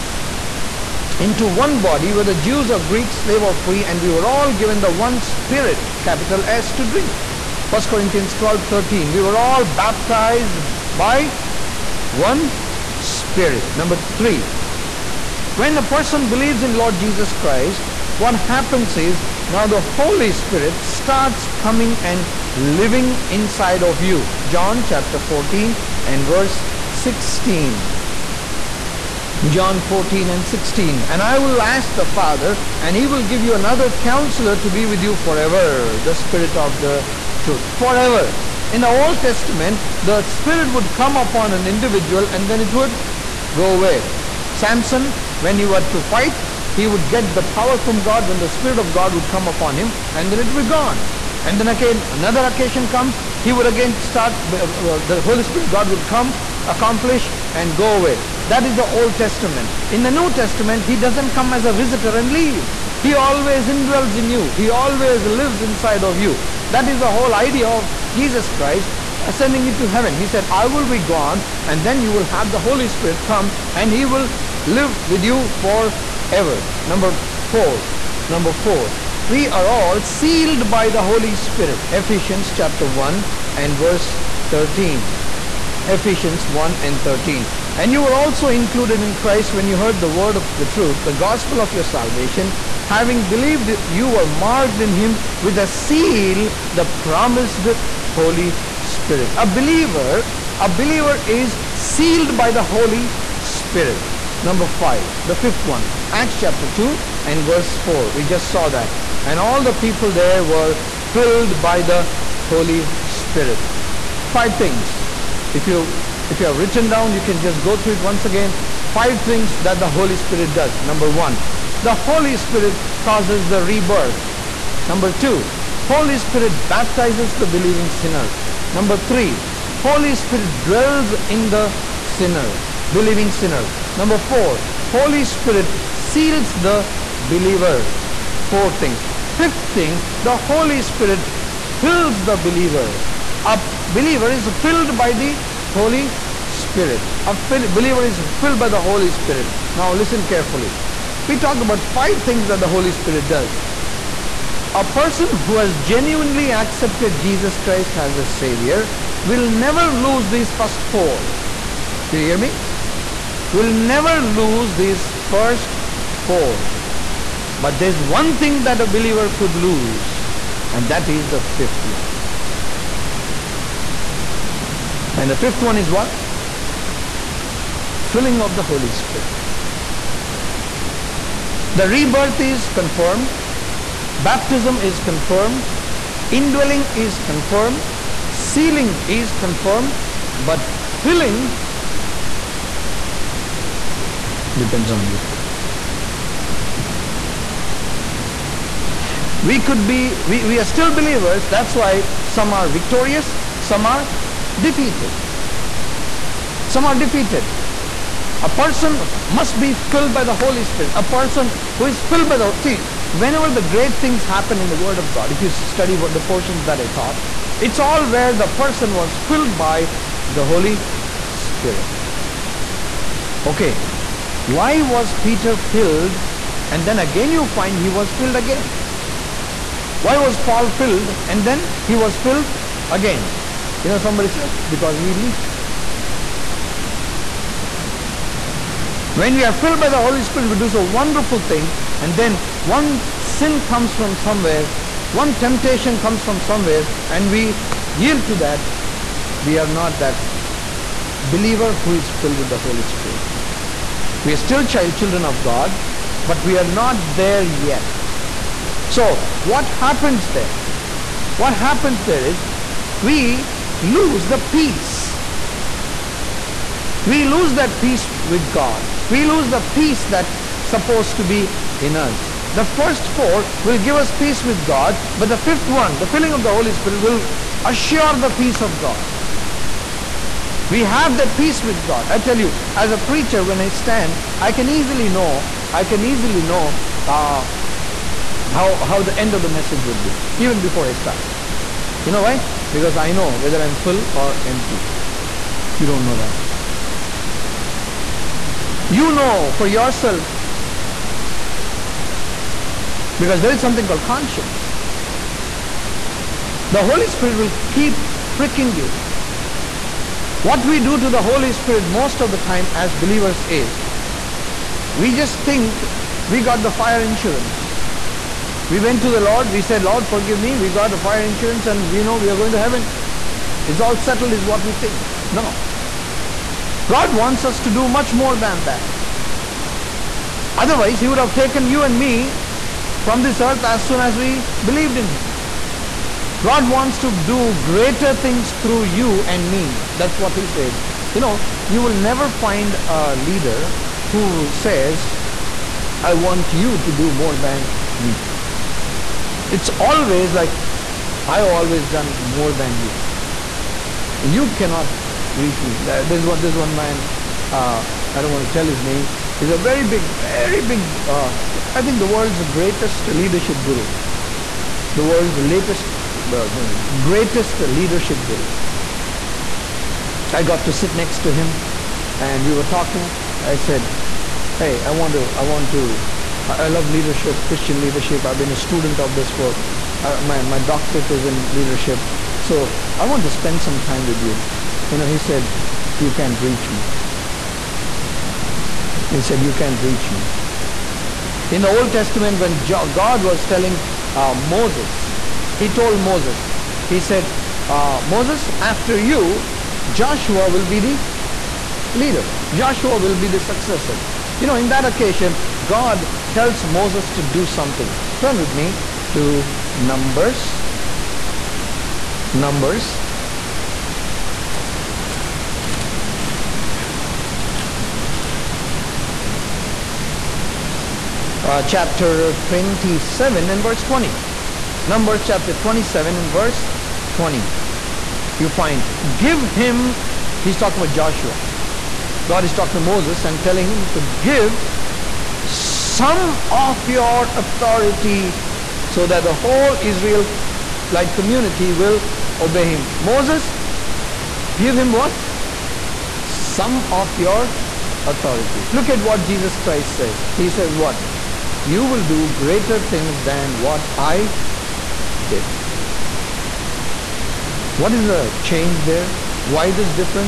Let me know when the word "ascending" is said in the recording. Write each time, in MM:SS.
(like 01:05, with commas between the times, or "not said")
01:09.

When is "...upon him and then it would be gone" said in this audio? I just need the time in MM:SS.
00:49.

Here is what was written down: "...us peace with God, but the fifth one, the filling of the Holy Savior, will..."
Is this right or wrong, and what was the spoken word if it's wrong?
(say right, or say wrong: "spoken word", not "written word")
wrong: "Spirit", not "Savior".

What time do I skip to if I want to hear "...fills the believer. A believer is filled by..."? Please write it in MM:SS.
02:21.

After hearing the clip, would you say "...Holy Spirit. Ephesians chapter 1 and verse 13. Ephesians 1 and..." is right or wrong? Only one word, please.
right.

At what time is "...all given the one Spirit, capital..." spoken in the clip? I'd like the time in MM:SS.
00:04.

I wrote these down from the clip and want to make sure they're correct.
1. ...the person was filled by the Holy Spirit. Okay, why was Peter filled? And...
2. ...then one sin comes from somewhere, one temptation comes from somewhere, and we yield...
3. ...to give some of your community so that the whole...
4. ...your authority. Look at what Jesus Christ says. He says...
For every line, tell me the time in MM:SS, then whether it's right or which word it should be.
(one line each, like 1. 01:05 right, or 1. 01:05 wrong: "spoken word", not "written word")
1. 03:38 right
2. 04:02 right
3. 07:13 wrong: "authority", not "community"
4. 07:27 right.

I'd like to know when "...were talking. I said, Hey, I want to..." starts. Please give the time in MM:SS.
06:12.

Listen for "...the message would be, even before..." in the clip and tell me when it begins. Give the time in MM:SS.
04:49.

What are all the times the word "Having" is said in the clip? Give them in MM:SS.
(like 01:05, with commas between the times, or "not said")
01:32.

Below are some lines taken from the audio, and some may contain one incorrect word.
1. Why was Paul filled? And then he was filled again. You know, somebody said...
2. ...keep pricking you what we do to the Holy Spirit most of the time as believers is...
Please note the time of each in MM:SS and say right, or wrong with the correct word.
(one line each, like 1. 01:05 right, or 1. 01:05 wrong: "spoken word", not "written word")
1. 03:50 right
2. 05:07 right.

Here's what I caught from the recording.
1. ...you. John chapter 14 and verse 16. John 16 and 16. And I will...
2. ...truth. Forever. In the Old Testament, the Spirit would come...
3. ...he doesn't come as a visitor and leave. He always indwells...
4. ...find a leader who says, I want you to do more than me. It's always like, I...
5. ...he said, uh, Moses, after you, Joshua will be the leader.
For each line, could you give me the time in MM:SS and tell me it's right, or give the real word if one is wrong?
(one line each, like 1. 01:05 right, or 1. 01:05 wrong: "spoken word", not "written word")
1. 00:24 wrong: "14", not "16"
2. 00:37 right
3. 01:00 right
4. 05:42 right
5. 06:36 right.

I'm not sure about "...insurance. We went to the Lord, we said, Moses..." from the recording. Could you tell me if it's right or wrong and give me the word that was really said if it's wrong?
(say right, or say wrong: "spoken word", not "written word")
wrong: "Lord", not "Moses".